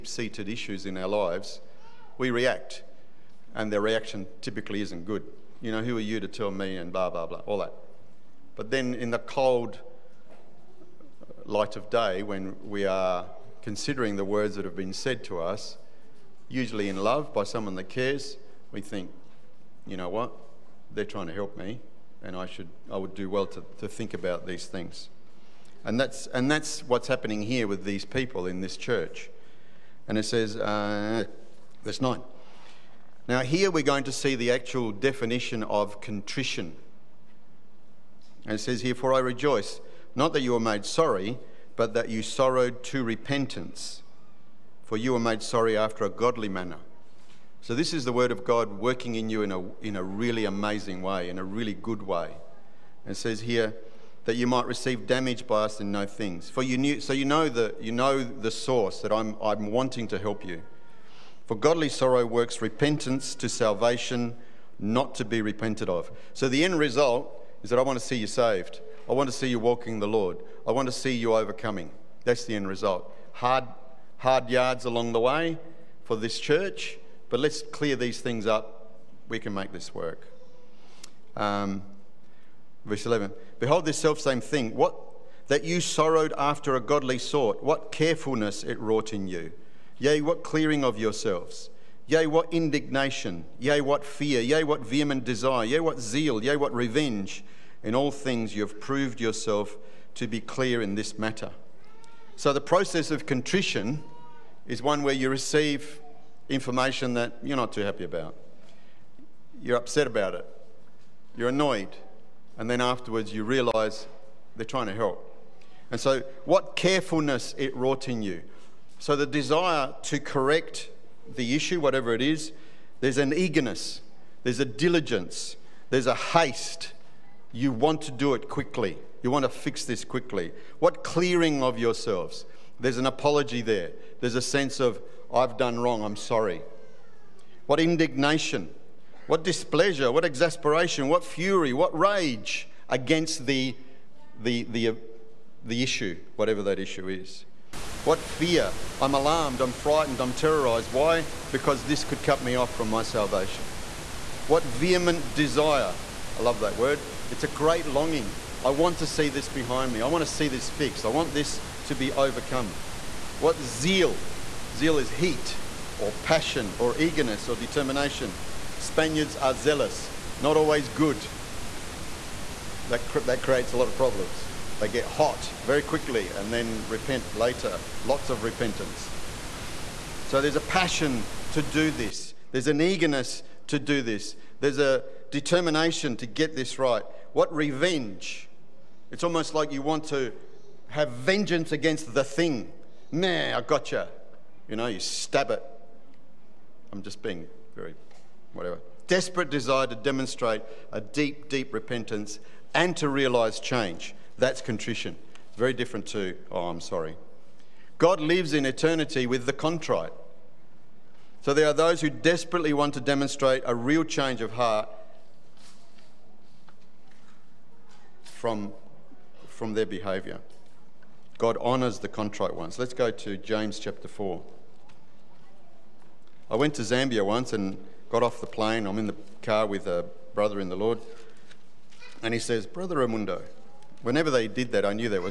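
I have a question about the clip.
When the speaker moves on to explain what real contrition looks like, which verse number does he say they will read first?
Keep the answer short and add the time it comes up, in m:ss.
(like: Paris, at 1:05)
9, at 0:31.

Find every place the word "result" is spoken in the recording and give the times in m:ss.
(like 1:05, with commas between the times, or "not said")
1:06, 1:12.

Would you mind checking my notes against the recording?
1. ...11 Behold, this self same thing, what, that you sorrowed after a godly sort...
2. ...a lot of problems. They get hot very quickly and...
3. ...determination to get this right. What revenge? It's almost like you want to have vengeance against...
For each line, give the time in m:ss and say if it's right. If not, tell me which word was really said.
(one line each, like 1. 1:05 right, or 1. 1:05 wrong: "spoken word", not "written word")
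1. 1:23 right
2. 2:53 right
3. 3:05 right.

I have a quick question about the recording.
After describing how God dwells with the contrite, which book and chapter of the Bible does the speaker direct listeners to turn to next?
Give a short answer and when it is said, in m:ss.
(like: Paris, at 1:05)
James chapter 4, at 3:43.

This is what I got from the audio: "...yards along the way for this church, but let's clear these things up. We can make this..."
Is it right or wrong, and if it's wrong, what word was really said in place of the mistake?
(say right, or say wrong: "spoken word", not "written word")
right.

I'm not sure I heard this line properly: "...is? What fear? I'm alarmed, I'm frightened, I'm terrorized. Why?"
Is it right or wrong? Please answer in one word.
right.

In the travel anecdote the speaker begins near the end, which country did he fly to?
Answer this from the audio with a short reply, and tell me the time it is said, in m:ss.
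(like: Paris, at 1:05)
Zambia, at 3:46.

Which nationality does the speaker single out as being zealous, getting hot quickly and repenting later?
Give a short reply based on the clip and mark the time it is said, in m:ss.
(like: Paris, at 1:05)
Spaniards, at 2:48.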